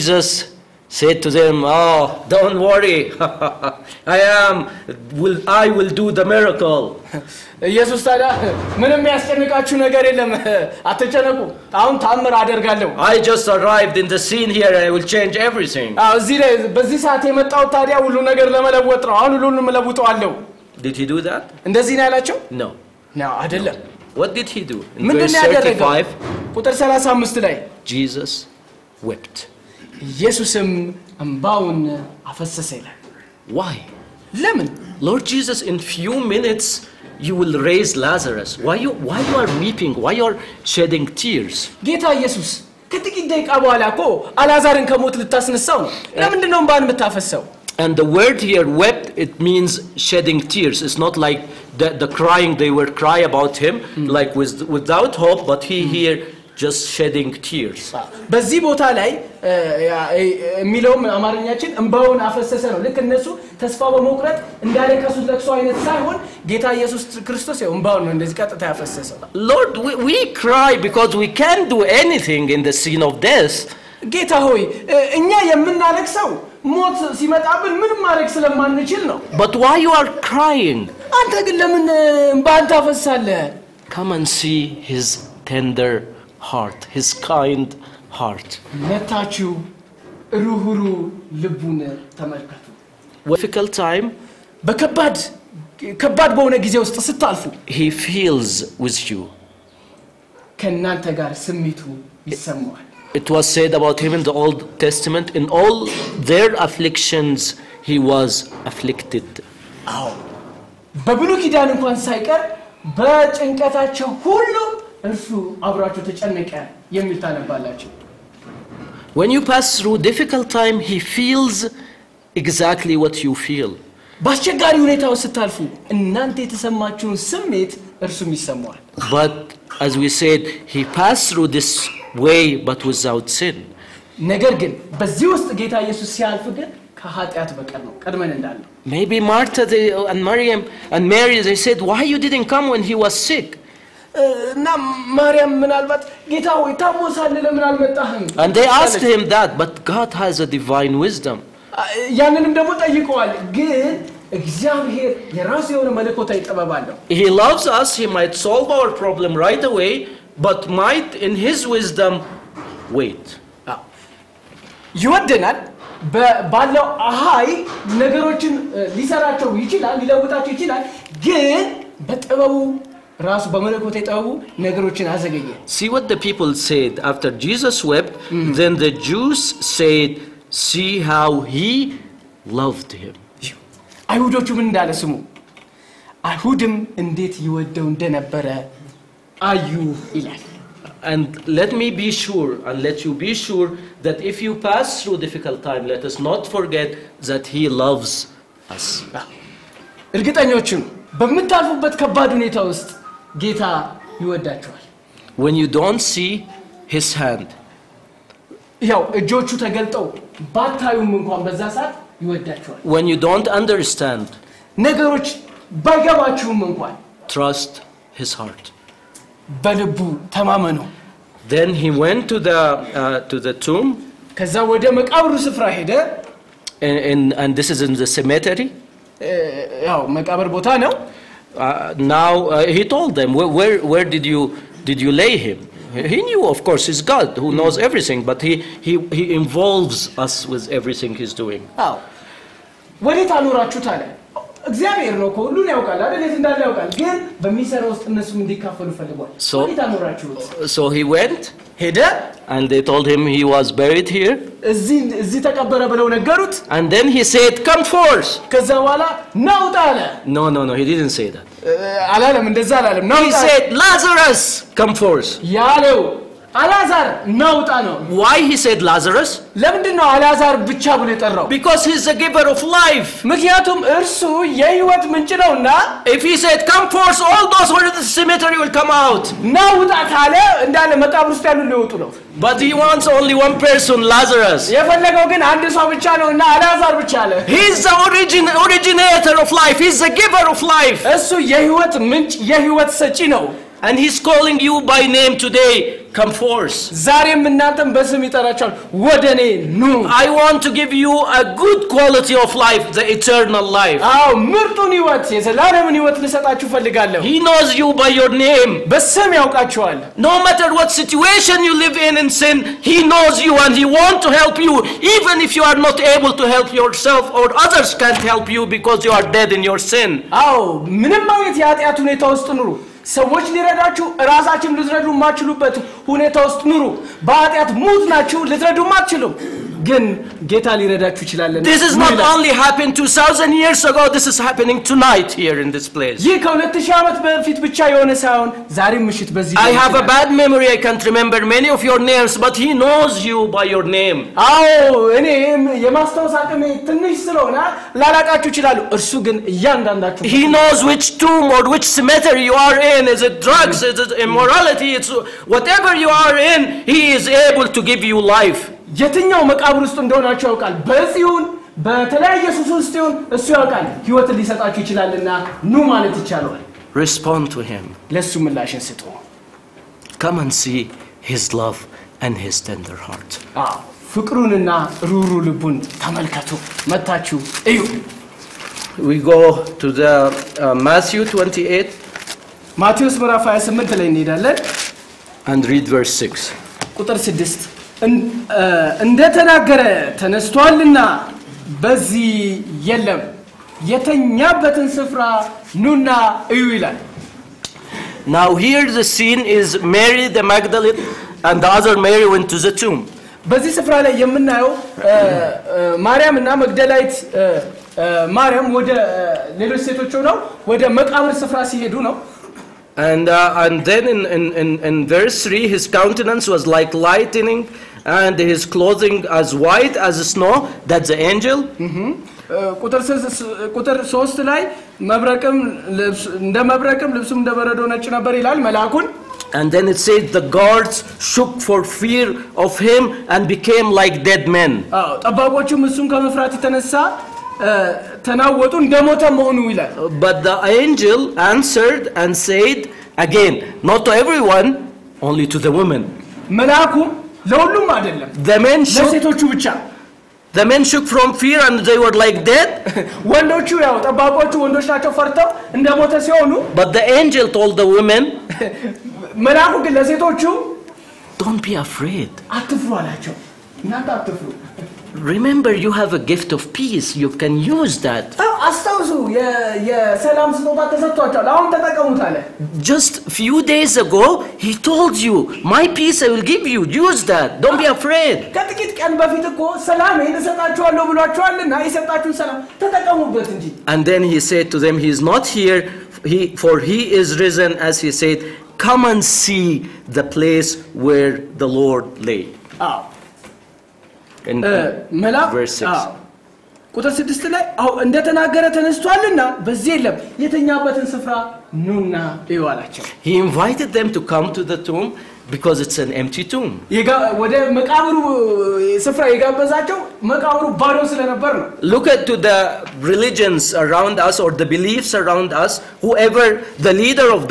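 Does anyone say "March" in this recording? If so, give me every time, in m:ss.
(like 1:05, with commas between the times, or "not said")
not said.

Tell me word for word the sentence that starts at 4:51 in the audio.
እሱ የህይወት ምንጭ የህይወት ሰጪ ነው። and he's calling you by name today.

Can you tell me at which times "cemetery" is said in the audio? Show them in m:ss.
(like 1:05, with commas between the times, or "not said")
3:48, 5:51.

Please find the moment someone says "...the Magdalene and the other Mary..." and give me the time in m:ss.
6:40.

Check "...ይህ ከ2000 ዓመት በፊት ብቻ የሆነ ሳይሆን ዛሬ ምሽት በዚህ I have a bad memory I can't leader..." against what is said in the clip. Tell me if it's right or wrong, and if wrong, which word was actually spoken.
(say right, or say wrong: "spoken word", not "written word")
wrong: "remember", not "leader".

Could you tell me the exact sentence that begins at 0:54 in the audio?
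like without hope, but he mm.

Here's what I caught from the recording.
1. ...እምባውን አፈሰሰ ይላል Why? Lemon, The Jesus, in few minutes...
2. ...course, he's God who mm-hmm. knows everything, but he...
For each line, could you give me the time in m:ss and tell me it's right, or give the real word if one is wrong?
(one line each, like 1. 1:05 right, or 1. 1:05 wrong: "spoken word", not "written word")
1. 0:31 wrong: "Lord", not "The"
2. 3:56 right.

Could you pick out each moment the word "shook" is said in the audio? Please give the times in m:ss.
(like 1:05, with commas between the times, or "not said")
7:11, 7:30.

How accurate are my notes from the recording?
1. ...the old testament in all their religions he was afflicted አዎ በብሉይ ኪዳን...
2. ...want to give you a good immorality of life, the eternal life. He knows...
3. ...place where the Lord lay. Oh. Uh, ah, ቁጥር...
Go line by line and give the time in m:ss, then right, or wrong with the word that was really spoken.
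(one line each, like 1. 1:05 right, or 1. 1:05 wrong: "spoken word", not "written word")
1. 1:44 wrong: "afflictions", not "religions"
2. 5:00 wrong: "quality", not "immorality"
3. 8:10 right.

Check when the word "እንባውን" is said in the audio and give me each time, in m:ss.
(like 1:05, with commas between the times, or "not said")
1:01, 1:07.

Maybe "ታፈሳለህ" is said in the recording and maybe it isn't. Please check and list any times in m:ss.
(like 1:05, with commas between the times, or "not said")
1:22.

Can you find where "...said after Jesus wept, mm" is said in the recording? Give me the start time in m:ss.
2:56.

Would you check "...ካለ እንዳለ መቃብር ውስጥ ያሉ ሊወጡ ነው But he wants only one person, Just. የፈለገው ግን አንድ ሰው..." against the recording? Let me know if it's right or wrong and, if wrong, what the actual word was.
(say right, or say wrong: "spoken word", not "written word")
wrong: "Lazarus", not "Just".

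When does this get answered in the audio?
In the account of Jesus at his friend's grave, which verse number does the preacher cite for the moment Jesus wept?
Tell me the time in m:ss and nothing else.
0:25.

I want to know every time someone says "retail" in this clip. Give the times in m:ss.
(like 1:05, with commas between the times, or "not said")
not said.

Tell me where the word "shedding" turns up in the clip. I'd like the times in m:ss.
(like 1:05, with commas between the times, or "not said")
0:40, 0:50, 0:56.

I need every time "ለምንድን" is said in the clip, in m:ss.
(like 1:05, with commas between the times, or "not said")
0:46, 4:29.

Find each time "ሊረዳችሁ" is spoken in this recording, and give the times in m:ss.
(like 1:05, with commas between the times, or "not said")
5:23, 5:30.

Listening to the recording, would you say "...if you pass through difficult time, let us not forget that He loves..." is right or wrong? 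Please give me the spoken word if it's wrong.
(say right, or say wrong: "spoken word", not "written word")
right.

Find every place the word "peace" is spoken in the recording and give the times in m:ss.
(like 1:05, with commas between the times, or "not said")
7:46, 7:55.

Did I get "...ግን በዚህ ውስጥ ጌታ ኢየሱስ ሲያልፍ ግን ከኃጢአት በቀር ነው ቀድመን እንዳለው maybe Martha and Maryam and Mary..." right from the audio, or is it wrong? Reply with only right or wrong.
right.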